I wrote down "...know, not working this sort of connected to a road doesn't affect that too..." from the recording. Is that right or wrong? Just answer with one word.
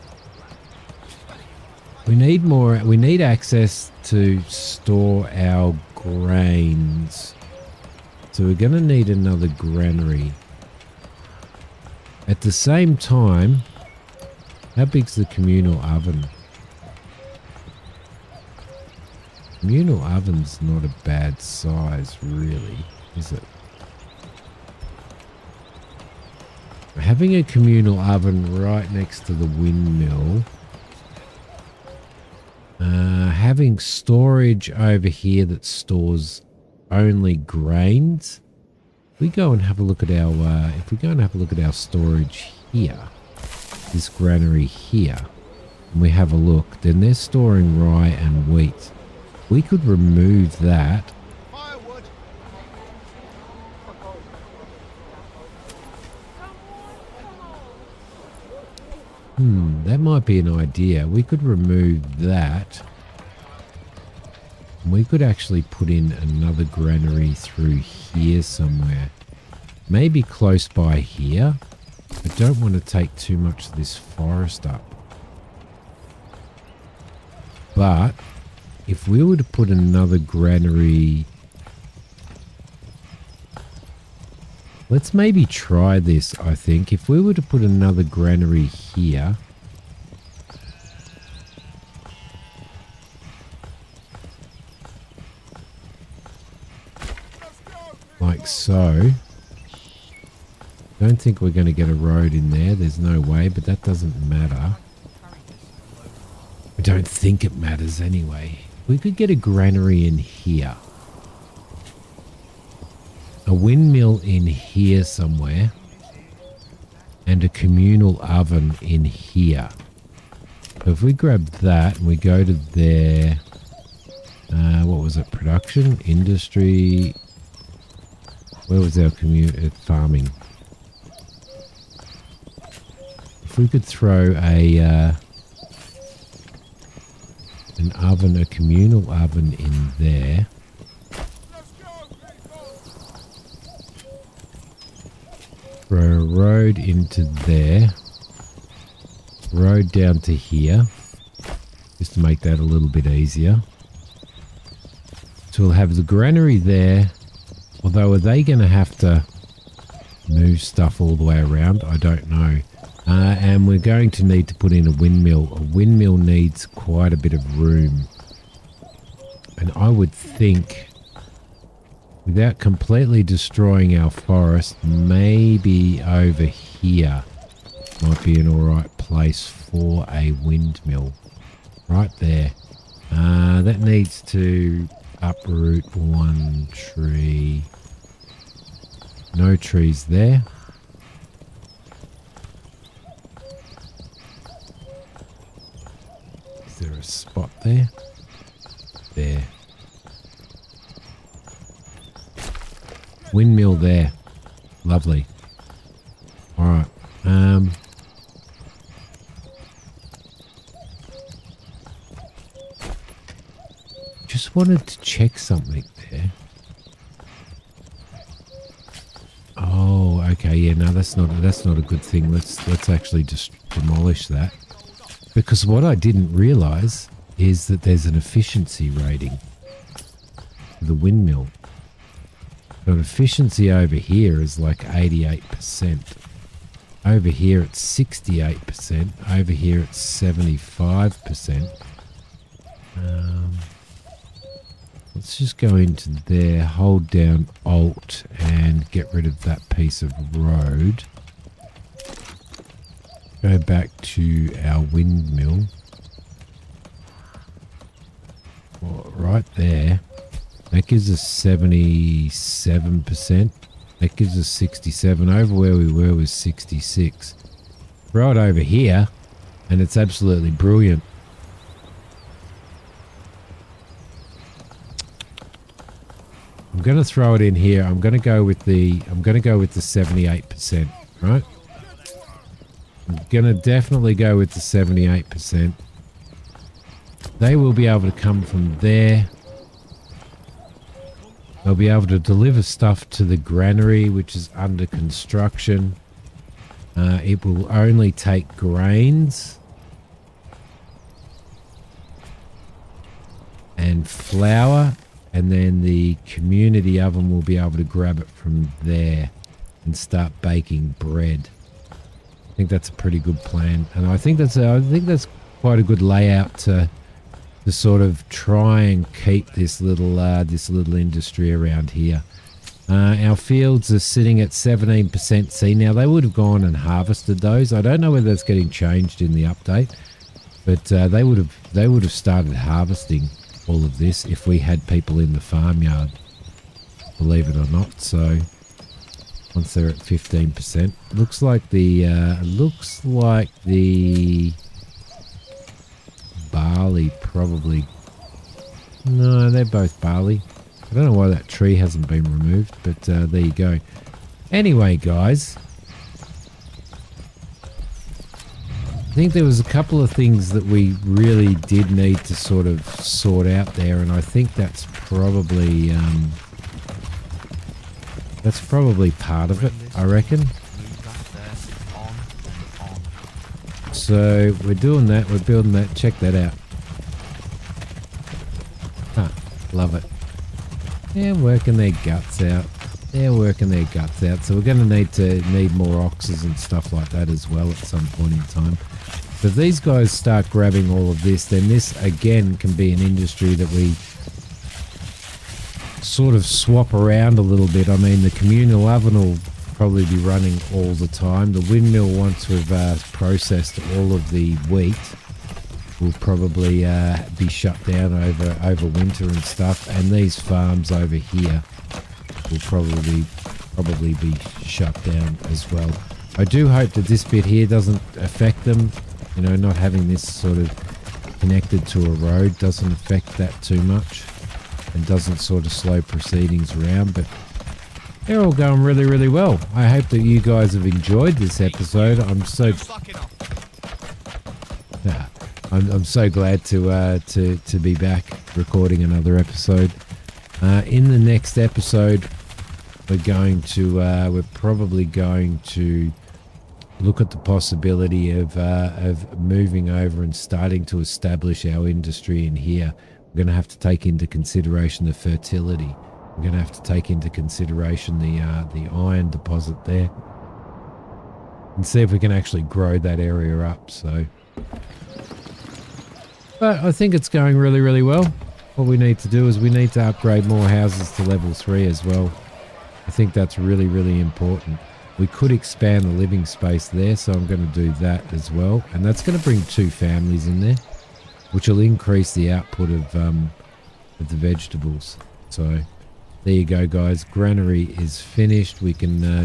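wrong.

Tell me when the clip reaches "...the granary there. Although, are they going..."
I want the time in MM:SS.
02:35.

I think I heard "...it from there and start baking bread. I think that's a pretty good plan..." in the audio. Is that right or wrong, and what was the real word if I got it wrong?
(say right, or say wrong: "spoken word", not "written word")
right.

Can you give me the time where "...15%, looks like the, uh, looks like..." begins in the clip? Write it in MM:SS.
05:39.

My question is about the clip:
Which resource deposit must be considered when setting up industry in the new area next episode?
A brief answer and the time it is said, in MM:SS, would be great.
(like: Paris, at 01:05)
iron, at 07:38.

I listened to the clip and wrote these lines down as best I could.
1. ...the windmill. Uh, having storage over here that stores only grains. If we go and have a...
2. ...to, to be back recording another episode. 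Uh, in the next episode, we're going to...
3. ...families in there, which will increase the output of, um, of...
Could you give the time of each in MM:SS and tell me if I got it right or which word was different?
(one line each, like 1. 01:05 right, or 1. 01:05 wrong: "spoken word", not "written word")
1. 00:29 right
2. 07:17 right
3. 07:59 right.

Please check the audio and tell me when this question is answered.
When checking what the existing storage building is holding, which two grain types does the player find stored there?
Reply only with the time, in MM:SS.
00:47.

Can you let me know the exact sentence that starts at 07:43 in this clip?
So, but I think it's going really really well.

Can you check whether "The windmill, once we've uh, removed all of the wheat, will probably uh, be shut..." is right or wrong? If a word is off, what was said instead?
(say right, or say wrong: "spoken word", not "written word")
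wrong: "processed", not "removed".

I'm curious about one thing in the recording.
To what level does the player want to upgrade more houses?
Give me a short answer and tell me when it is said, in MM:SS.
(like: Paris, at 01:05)
level 3, at 07:51.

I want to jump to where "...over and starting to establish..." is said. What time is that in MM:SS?
07:29.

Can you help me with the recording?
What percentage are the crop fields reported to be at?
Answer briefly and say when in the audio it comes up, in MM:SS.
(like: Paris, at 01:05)
17%, at 05:24.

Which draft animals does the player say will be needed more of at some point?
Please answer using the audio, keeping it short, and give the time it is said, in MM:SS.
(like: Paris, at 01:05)
oxes, at 06:26.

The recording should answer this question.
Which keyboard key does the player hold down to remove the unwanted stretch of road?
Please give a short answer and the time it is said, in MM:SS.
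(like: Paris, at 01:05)
Alt, at 04:07.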